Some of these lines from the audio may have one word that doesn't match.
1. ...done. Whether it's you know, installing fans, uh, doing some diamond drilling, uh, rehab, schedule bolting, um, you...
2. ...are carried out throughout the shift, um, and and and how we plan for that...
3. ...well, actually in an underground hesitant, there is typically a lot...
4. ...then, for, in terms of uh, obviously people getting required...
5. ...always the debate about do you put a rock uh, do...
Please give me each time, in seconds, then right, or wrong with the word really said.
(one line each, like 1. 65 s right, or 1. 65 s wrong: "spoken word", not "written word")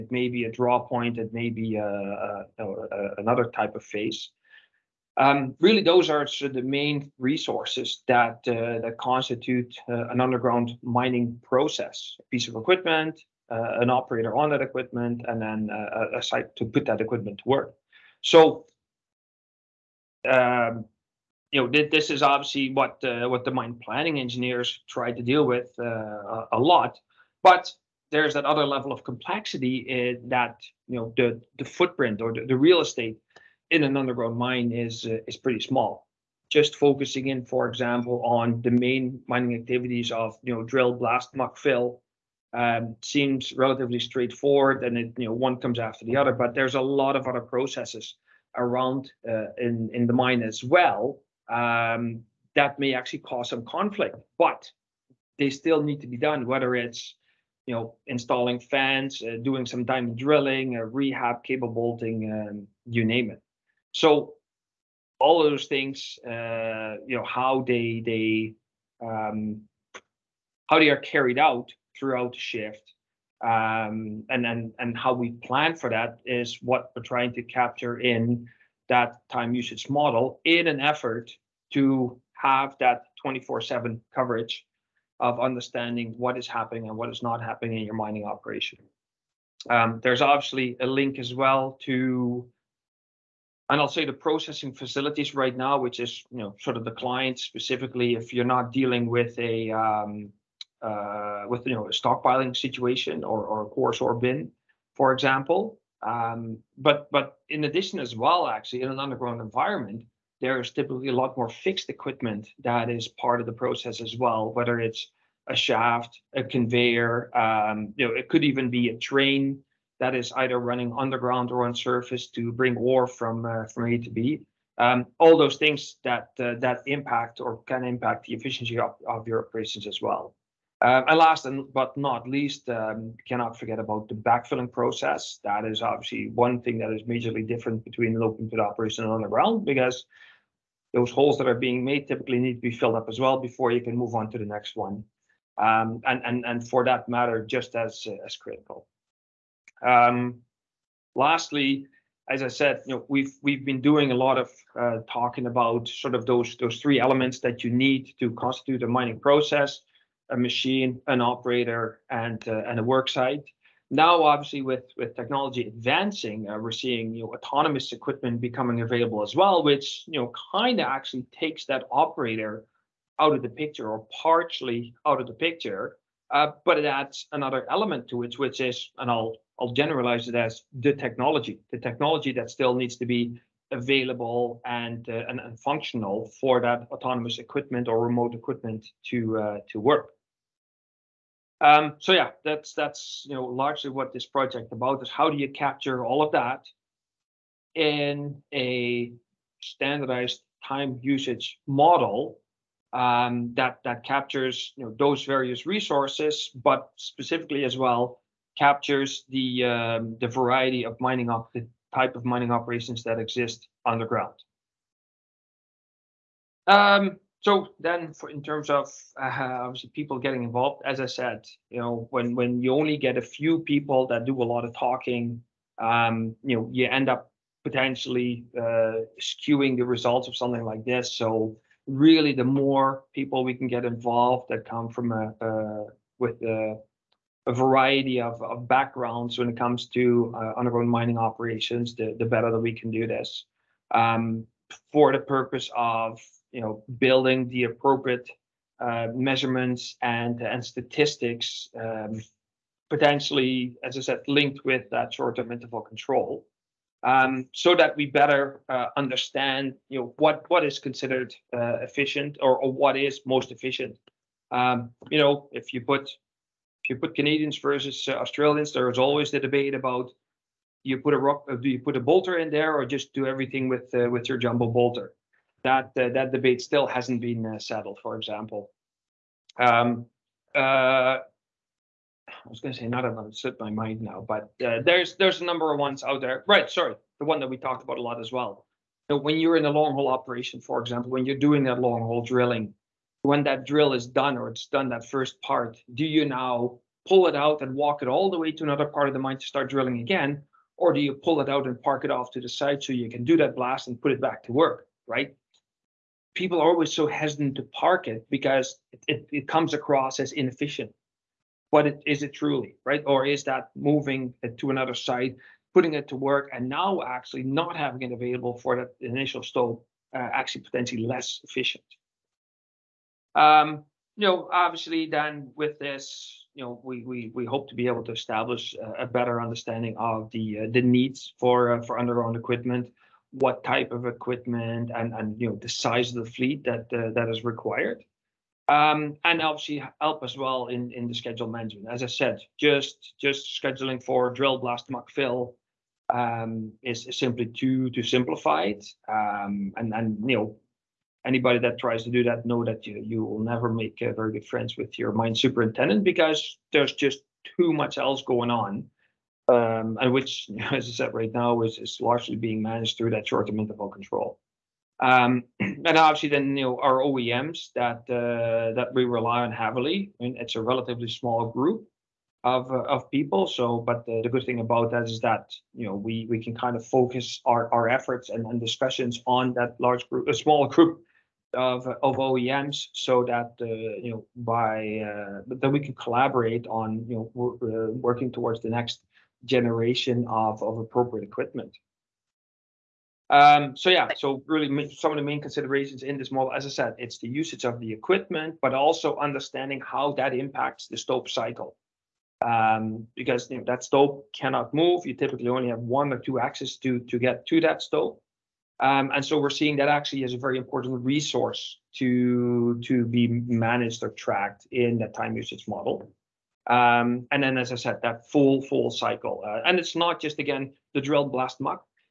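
1. 56 s wrong: "cable", not "schedule"
2. 70 s right
3. 108 s wrong: "environment", not "hesitant"
4. 217 s wrong: "involved", not "required"
5. 268 s right.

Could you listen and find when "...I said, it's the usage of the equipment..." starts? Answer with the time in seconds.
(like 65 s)
396 s.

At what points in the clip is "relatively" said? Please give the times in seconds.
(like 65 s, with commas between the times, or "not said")
43 s, 370 s.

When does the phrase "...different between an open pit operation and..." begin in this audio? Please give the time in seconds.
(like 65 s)
137 s.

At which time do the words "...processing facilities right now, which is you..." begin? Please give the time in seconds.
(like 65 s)
94 s.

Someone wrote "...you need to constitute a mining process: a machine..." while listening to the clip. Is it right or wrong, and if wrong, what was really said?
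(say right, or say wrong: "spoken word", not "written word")
right.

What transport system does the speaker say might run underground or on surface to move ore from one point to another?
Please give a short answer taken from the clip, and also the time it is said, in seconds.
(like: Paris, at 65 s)
a train, at 118 s.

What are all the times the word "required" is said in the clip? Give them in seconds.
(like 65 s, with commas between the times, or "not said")
337 s.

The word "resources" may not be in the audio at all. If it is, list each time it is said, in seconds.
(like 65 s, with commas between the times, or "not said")
7 s, 205 s, 411 s.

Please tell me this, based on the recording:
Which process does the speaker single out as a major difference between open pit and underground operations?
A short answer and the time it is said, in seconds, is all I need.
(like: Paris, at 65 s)
backfilling, at 134 s.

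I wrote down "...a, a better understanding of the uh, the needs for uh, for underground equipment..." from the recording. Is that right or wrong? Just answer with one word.
right.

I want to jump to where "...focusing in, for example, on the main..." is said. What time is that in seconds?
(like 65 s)
36 s.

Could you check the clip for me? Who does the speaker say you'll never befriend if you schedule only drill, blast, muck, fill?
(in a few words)
mine superintendent.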